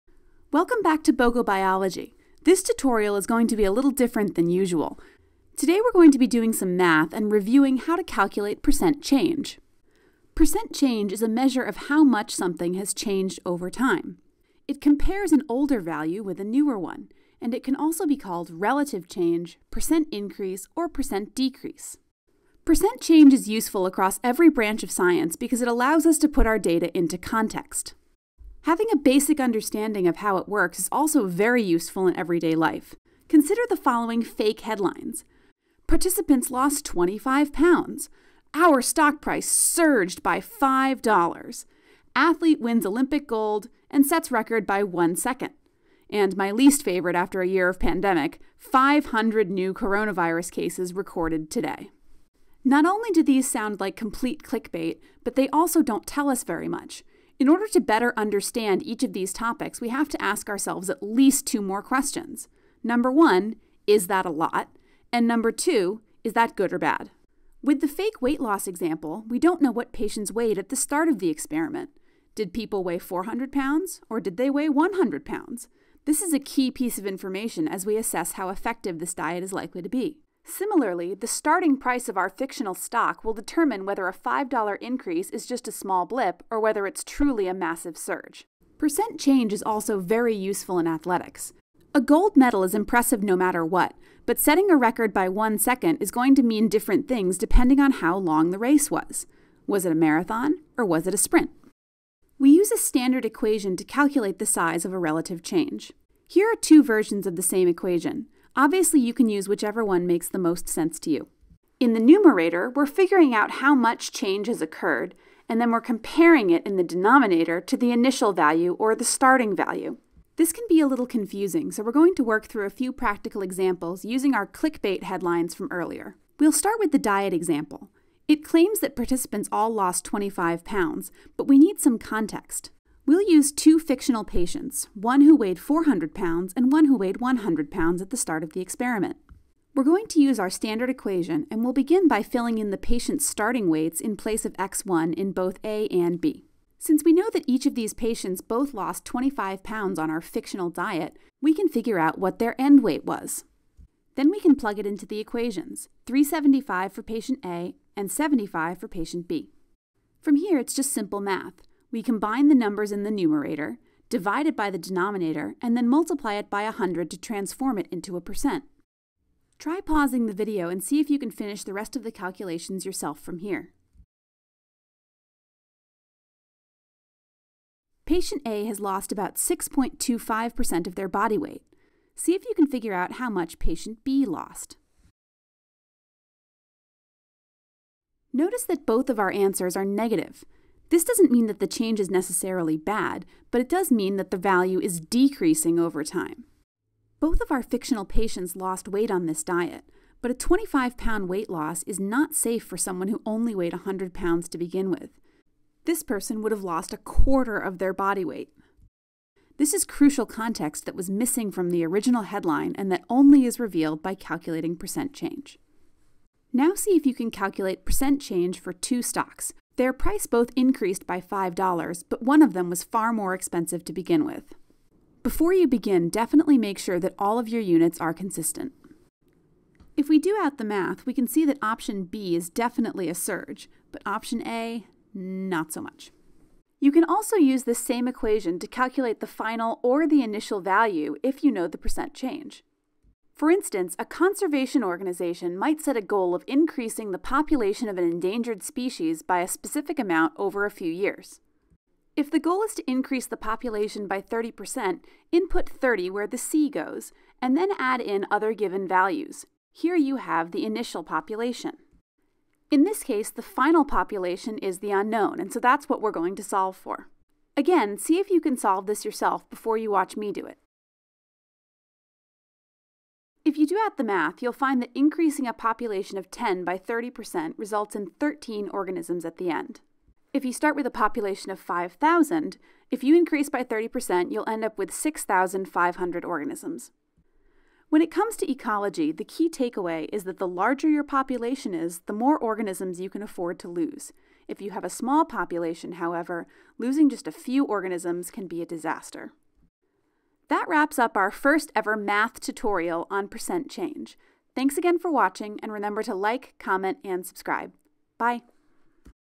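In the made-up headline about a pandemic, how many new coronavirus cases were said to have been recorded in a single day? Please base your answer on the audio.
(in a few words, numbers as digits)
500.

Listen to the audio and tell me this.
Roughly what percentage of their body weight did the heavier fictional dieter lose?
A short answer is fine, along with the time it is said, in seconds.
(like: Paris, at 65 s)
6.25%, at 179 s.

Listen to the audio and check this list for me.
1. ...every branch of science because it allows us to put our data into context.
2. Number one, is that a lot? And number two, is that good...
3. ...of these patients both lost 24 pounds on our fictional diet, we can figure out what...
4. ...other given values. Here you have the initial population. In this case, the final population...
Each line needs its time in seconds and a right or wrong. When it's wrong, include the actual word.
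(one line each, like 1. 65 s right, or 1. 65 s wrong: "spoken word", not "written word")
1. 24 s right
2. 62 s right
3. 147 s wrong: "25", not "24"
4. 258 s right.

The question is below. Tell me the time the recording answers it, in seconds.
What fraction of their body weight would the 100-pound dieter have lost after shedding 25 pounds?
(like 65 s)
206 s.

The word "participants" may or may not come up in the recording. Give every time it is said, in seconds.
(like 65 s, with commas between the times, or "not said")
35 s, 128 s.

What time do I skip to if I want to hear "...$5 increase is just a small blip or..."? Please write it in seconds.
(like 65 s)
84 s.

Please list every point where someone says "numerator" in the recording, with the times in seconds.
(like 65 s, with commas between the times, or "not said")
111 s, 163 s.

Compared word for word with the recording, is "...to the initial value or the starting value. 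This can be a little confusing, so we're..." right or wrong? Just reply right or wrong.
right.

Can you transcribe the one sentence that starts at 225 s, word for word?
Before you begin, definitely make sure that all of your units are consistent.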